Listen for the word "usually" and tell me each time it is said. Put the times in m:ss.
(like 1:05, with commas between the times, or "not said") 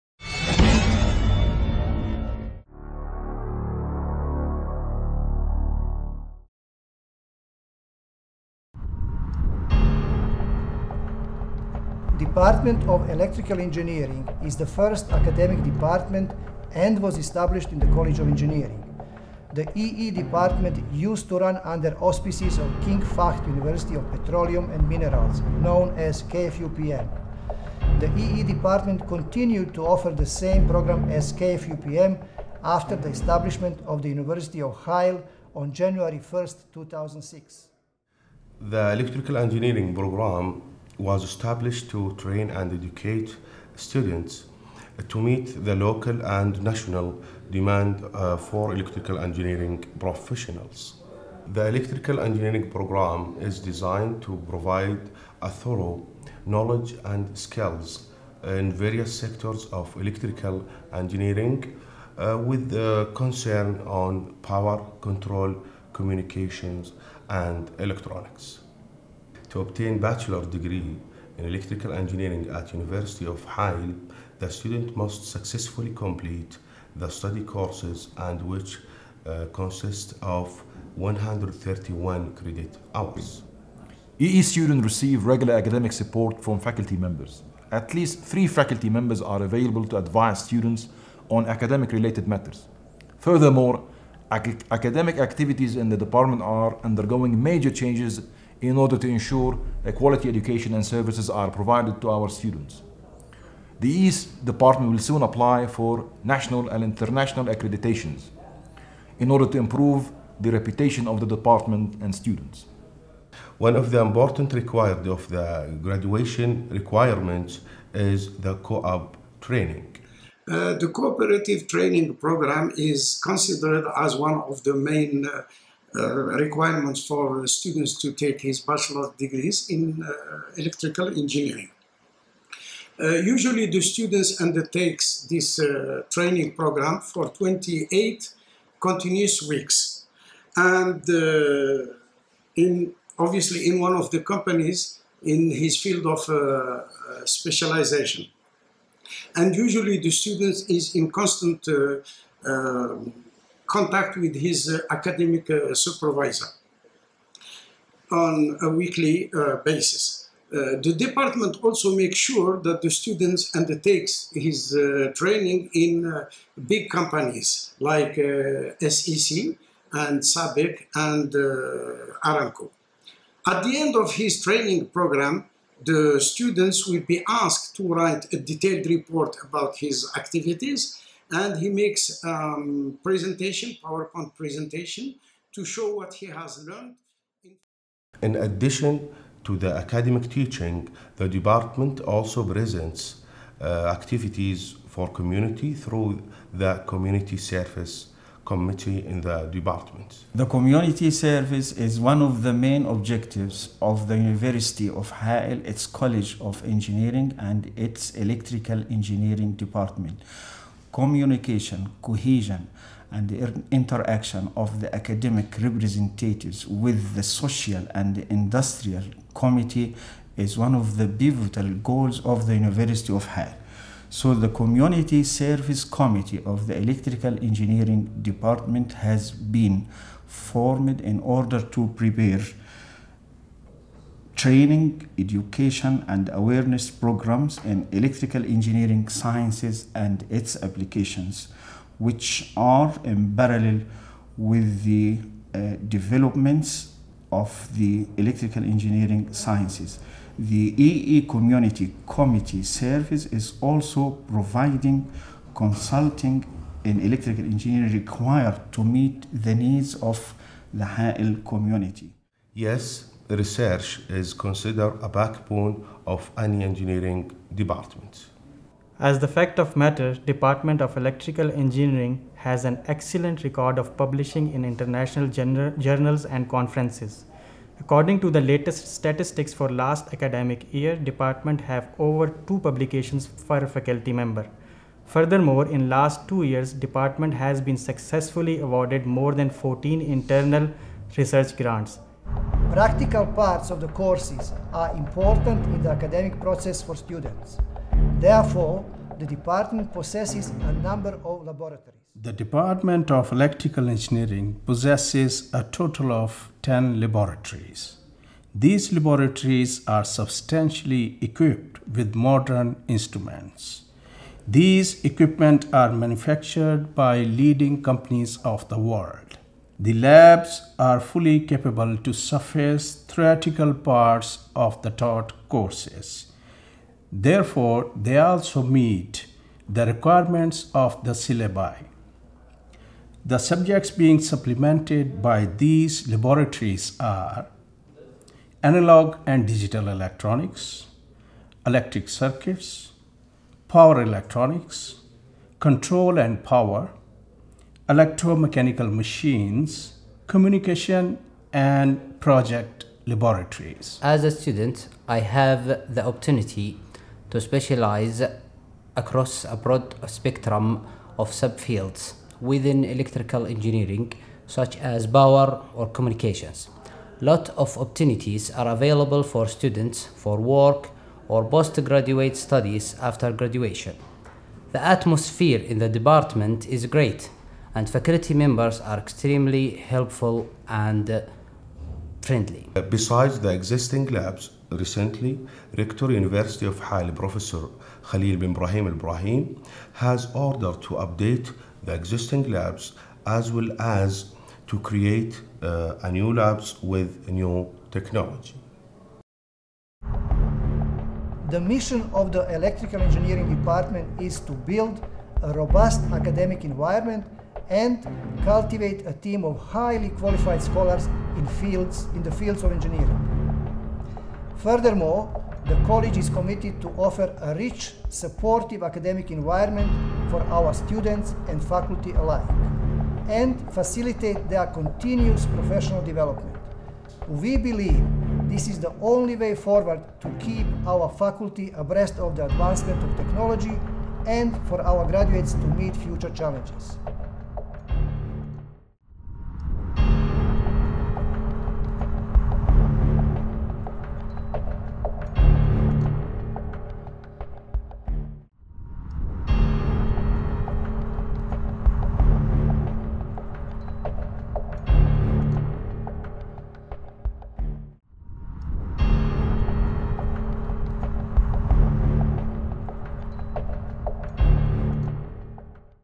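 2:13, 2:29.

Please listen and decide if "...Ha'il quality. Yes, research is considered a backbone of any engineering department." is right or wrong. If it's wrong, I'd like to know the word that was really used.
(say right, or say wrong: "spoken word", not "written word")
wrong: "community", not "quality".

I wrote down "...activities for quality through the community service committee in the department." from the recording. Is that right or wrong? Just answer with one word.
wrong.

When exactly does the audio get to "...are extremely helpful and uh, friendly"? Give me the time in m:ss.
6:18.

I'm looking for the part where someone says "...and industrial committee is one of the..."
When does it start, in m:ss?
3:37.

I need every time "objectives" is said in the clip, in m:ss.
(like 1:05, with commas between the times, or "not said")
3:22.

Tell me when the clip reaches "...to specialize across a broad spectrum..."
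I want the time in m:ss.
5:57.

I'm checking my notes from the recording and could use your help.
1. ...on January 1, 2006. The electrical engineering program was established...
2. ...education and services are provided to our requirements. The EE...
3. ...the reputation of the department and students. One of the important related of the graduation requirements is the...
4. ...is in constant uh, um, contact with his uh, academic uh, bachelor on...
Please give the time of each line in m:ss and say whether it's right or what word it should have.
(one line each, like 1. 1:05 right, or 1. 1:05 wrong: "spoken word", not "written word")
1. 0:35 right
2. 1:40 wrong: "students", not "requirements"
3. 1:50 wrong: "required", not "related"
4. 2:30 wrong: "supervisor", not "bachelor".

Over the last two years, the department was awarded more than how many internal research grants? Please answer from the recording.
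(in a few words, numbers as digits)
14.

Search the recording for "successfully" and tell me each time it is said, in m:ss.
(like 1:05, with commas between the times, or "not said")
1:15, 4:47.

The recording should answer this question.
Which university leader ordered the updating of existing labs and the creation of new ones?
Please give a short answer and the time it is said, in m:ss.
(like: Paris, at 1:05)
Khalil bin Ibrahim Ibrahim, at 6:28.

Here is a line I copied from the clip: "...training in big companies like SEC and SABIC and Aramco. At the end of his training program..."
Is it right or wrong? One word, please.
right.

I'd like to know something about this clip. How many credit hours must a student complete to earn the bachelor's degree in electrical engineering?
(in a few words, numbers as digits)
131.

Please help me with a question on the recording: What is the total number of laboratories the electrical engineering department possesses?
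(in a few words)
10.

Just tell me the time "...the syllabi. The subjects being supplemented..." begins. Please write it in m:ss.
5:31.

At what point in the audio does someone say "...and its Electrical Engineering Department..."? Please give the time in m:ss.
3:27.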